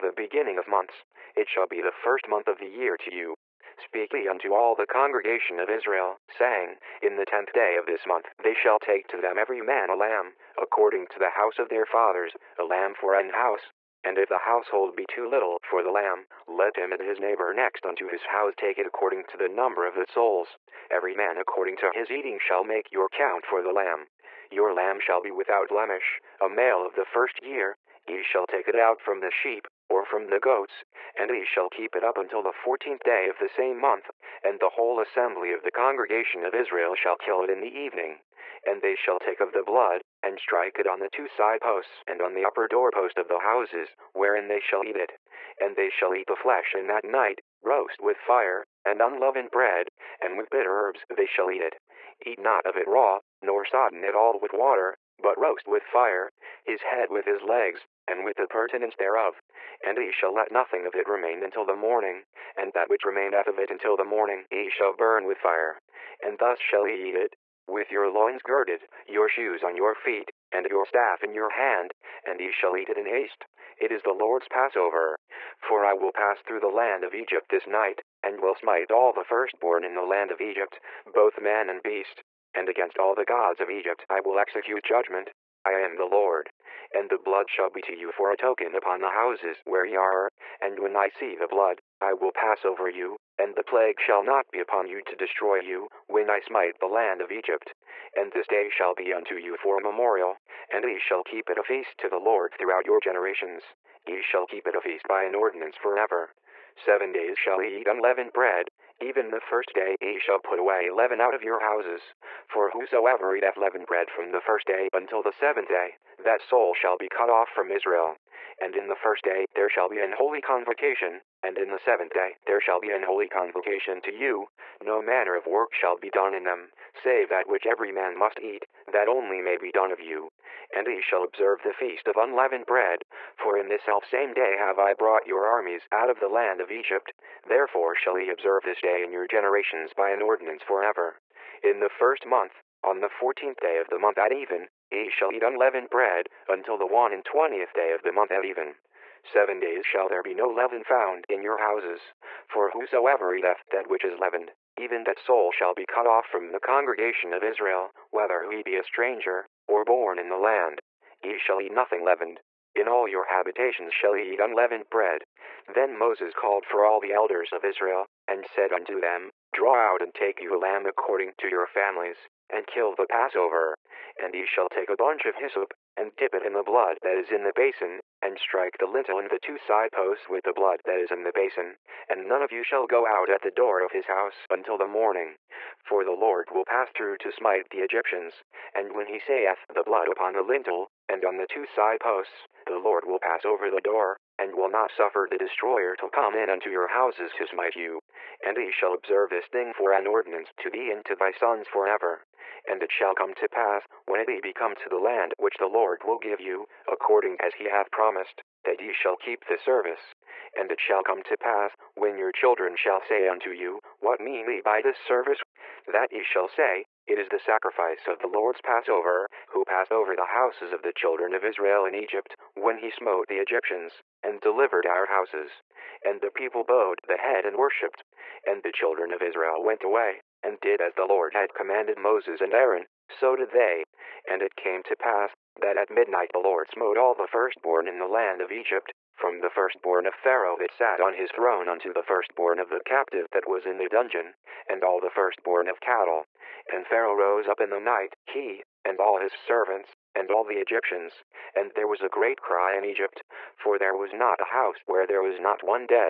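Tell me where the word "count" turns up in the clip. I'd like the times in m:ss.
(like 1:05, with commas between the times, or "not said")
0:23.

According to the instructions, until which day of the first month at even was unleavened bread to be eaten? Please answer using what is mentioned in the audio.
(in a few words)
21st day.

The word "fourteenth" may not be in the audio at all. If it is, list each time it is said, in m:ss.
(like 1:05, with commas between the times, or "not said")
0:32, 2:23.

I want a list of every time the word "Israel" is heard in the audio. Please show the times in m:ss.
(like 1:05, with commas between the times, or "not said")
0:05, 0:36, 1:57, 2:37, 2:47, 3:41, 3:49.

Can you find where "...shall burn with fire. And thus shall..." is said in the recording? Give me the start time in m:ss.
1:04.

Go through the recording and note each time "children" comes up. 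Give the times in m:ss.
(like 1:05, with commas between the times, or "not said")
3:32, 3:40, 3:48.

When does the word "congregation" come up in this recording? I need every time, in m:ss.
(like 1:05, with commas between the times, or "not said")
0:04, 0:35, 2:36.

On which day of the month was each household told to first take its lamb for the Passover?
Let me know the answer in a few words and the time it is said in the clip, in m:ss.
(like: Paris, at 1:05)
10th day, at 0:07.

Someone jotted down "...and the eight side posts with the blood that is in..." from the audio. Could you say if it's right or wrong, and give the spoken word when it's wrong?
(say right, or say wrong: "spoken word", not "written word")
wrong: "two", not "eight".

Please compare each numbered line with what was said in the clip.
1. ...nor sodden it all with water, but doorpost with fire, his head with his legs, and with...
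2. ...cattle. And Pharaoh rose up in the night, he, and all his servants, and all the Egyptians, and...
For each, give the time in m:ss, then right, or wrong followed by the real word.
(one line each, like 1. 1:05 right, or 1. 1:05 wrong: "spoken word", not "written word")
1. 0:53 wrong: "roast", not "doorpost"
2. 4:05 right.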